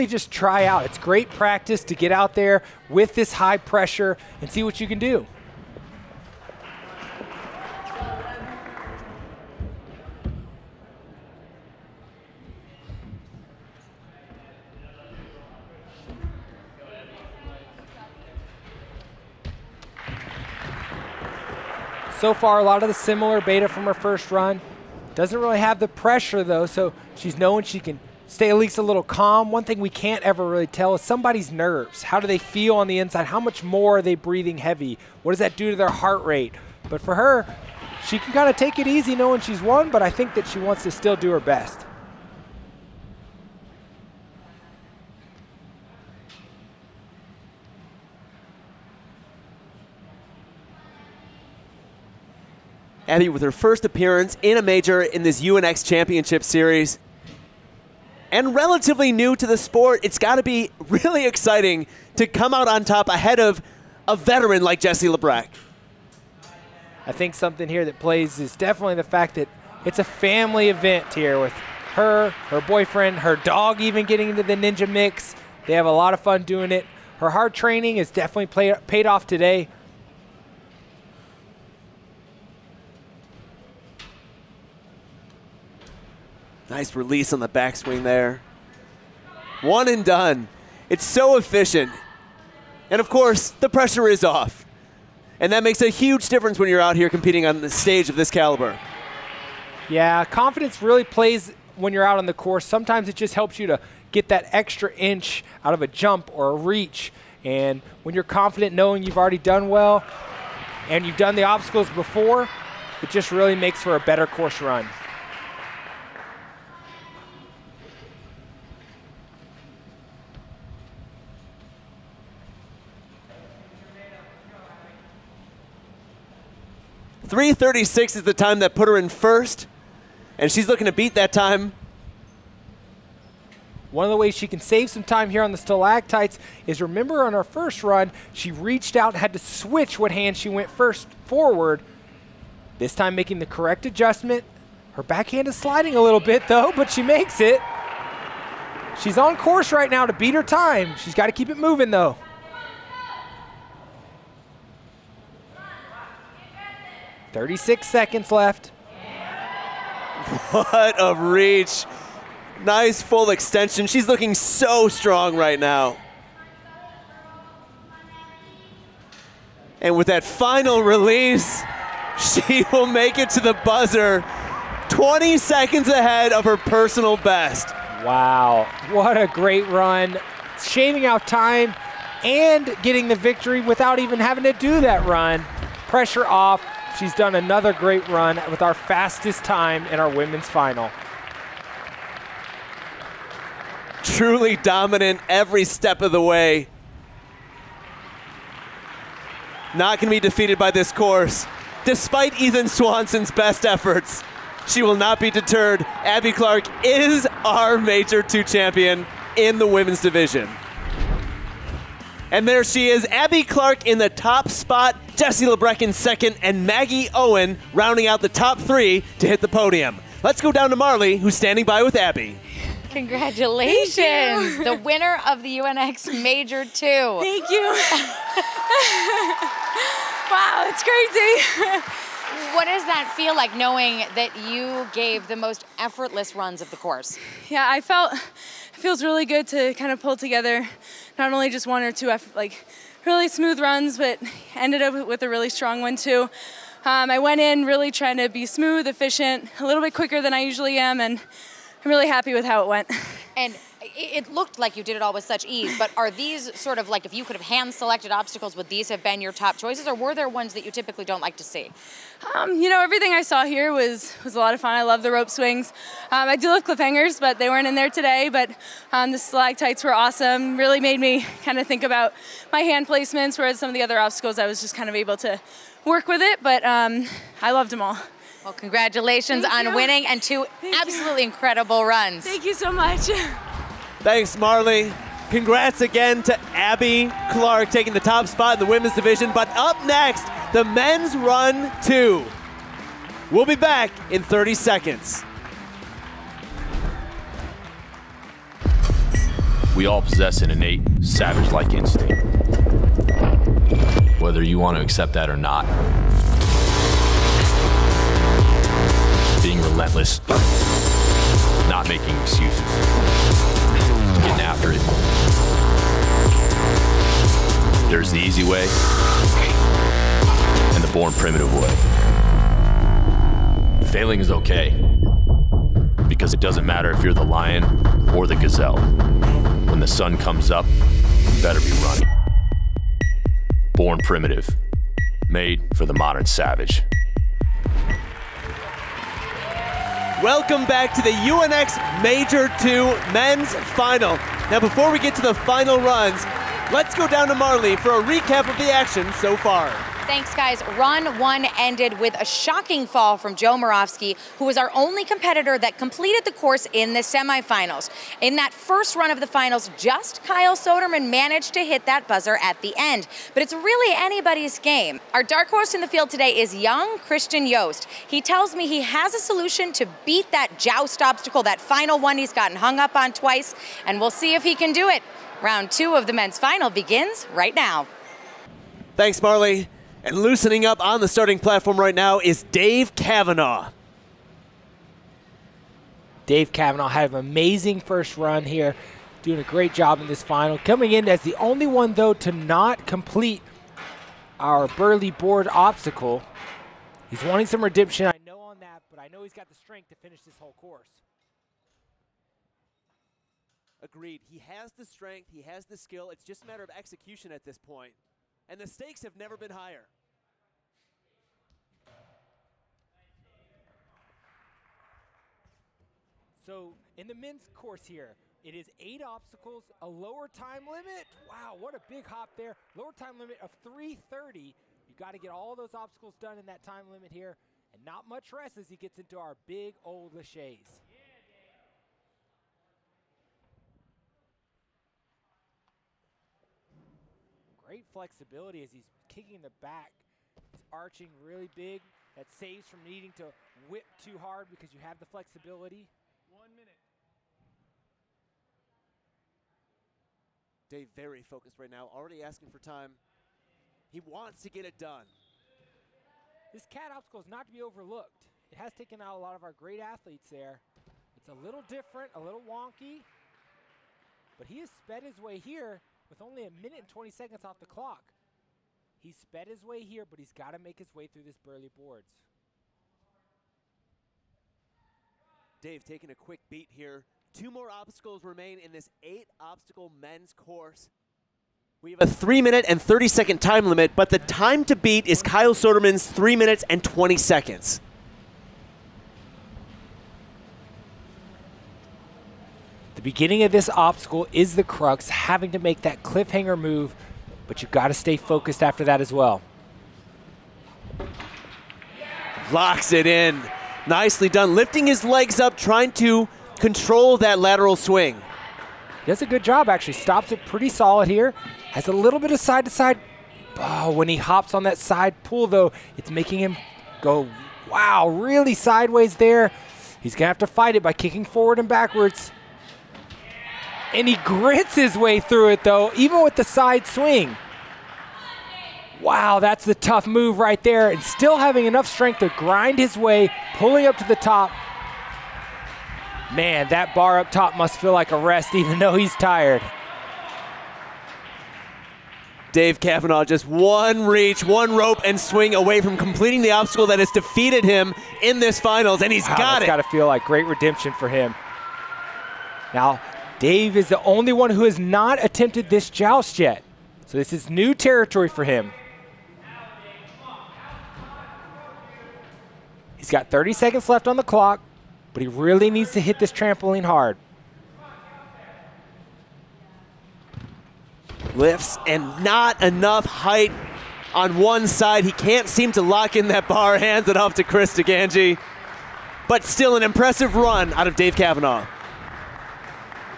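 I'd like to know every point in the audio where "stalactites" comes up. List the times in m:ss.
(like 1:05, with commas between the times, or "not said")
2:15, 4:29.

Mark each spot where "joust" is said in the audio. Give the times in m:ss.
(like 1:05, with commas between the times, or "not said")
6:10, 9:15.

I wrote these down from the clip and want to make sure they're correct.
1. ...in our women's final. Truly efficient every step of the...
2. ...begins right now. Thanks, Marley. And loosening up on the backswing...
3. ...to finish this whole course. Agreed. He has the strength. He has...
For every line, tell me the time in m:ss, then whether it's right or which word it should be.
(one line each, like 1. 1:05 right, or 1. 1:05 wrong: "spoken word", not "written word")
1. 3:09 wrong: "dominant", not "efficient"
2. 6:16 wrong: "starting", not "backswing"
3. 6:39 right.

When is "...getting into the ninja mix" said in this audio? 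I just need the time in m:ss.
1:14.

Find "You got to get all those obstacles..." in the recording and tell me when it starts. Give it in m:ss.
7:04.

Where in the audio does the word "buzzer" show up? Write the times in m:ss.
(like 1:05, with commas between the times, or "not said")
2:53, 6:02.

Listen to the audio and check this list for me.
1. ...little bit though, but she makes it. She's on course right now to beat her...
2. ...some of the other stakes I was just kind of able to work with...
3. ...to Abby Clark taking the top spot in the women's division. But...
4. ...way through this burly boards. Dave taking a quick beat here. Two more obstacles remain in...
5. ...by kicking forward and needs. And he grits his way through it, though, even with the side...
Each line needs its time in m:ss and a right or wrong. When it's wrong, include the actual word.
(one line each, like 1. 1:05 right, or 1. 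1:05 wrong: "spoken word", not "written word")
1. 2:26 right
2. 4:33 wrong: "obstacles", not "stakes"
3. 4:46 right
4. 7:50 right
5. 8:40 wrong: "backwards", not "needs".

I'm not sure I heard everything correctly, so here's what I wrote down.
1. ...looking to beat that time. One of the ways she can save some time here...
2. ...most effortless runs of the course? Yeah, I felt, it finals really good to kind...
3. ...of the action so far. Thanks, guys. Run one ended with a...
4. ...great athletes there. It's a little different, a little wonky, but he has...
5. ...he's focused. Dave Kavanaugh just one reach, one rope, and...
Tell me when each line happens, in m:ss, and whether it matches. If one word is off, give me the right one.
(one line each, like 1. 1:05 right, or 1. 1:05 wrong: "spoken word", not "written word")
1. 2:10 right
2. 3:55 wrong: "feels", not "finals"
3. 5:48 right
4. 7:39 right
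5. 8:58 wrong: "tired", not "focused".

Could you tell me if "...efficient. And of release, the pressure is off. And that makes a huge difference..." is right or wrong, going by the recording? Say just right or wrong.
wrong.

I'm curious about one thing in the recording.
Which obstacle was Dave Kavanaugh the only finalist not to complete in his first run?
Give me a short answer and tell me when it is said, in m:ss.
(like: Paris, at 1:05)
burly board, at 6:34.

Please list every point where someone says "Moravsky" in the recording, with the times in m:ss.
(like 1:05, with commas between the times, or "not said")
5:53.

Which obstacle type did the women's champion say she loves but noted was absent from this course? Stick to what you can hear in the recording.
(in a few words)
cliffhangers.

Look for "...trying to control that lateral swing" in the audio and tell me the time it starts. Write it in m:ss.
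8:25.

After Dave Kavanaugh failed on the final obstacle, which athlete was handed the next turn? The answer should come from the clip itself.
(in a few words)
Chris DiGangi.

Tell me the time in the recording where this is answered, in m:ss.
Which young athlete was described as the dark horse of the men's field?
6:06.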